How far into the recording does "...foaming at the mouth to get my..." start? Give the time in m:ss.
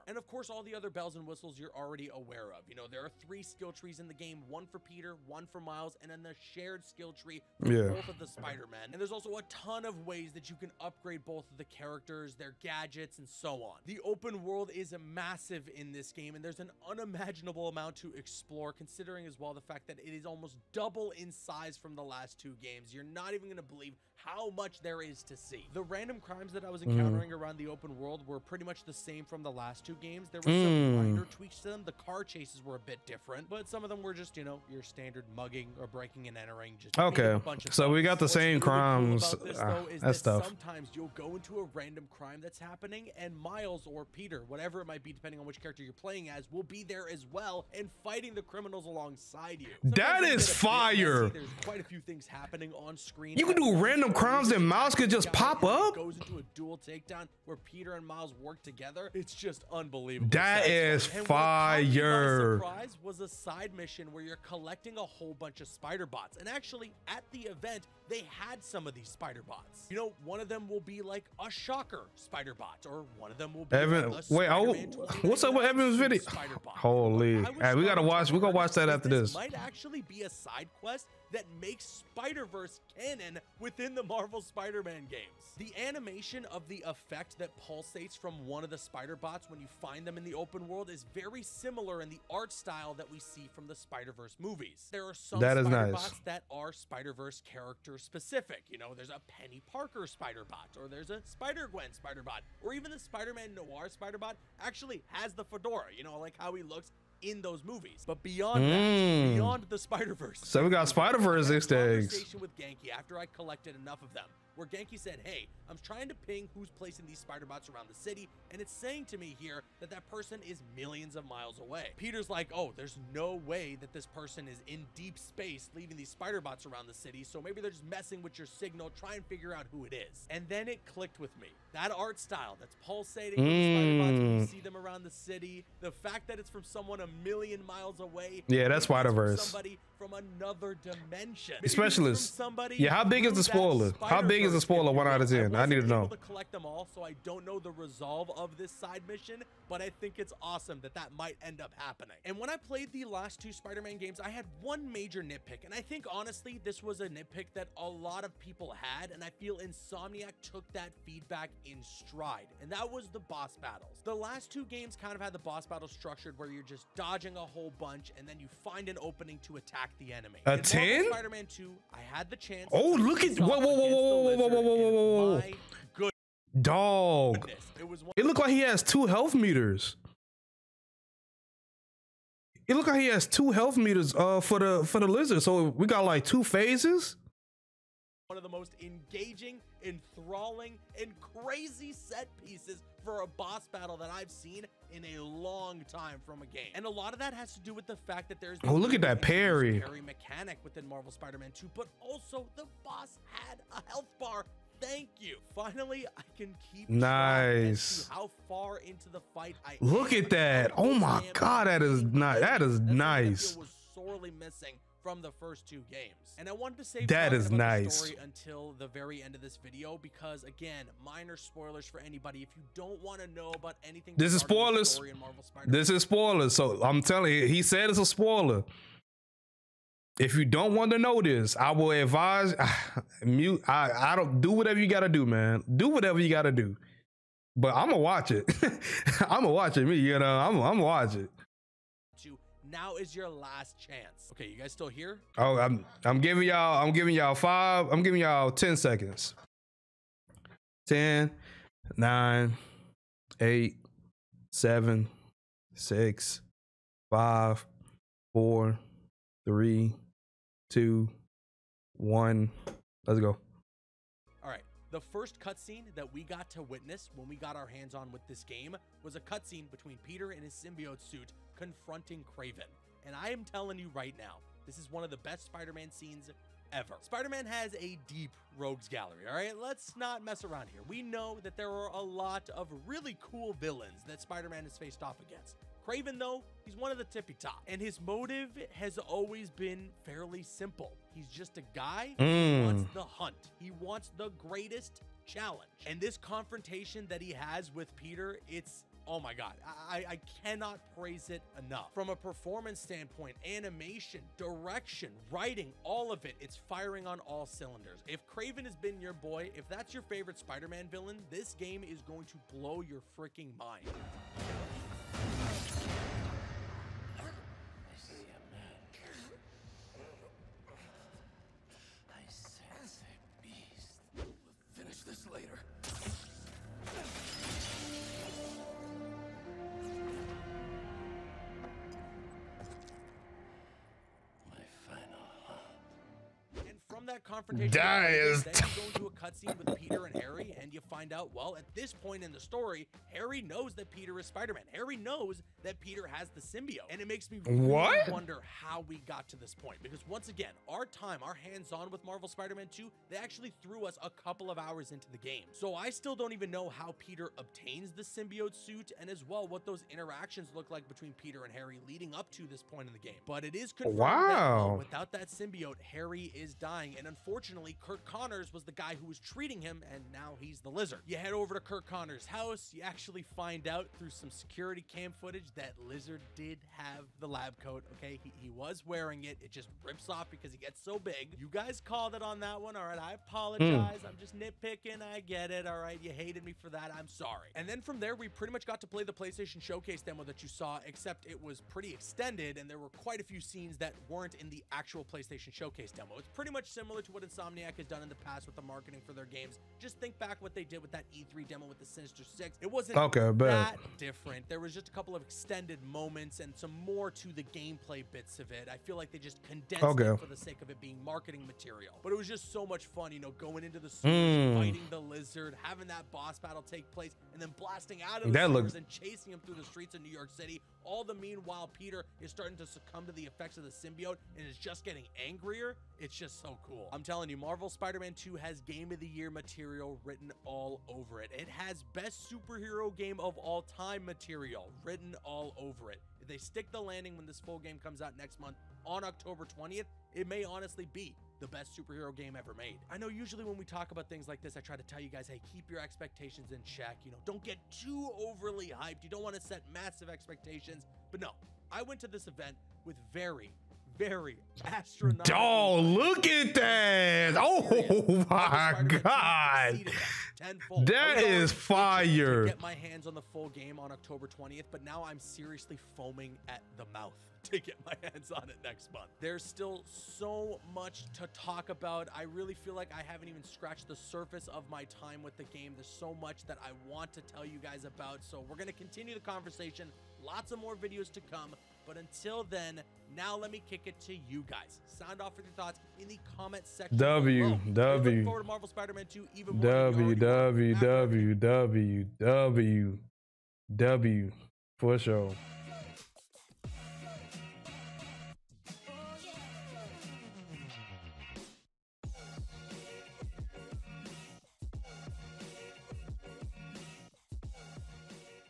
7:45.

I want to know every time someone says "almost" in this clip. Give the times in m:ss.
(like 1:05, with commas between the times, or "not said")
0:20.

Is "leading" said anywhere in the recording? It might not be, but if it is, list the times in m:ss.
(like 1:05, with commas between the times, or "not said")
6:01.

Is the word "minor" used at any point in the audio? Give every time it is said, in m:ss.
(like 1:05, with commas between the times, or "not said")
0:31, 3:41.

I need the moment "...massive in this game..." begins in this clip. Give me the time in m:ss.
0:15.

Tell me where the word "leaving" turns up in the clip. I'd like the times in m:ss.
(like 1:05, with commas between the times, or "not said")
2:05.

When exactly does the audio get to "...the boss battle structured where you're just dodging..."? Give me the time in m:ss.
2:45.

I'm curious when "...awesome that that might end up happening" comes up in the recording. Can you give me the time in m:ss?
2:30.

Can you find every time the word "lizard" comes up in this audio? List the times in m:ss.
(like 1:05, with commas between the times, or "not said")
3:05, 6:10, 6:15, 6:54.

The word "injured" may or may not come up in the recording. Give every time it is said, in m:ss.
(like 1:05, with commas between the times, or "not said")
not said.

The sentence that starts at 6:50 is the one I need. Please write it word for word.
it for the sake of it being marketing material.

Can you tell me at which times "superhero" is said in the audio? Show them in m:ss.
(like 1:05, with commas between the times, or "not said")
7:12, 7:21.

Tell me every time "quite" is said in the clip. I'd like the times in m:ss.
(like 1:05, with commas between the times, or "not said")
0:51, 6:32.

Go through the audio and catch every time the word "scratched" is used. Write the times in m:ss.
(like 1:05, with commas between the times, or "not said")
7:53.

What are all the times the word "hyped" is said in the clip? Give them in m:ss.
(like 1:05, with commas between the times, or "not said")
7:28.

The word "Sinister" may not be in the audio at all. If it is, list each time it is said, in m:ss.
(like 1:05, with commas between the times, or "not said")
6:41.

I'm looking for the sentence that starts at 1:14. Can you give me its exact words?
Like wait, what's up with Evan's video?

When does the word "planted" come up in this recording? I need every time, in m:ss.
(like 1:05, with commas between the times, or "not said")
not said.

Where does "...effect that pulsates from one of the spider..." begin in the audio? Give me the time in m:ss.
1:26.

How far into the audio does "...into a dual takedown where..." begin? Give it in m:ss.
0:56.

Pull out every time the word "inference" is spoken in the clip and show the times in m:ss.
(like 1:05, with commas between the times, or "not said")
not said.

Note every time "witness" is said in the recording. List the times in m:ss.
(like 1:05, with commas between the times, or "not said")
4:26.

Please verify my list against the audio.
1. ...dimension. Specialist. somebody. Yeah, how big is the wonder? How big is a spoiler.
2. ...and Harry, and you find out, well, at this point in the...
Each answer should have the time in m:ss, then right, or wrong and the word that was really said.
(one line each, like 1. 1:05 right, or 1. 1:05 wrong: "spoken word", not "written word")
1. 2:20 wrong: "spoiler", not "wonder"
2. 5:40 right.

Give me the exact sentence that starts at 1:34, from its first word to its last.
There are some that is spider nice.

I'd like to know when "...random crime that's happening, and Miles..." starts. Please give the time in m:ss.
0:41.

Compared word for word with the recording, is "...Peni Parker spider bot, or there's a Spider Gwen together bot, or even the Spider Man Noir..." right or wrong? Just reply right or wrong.
wrong.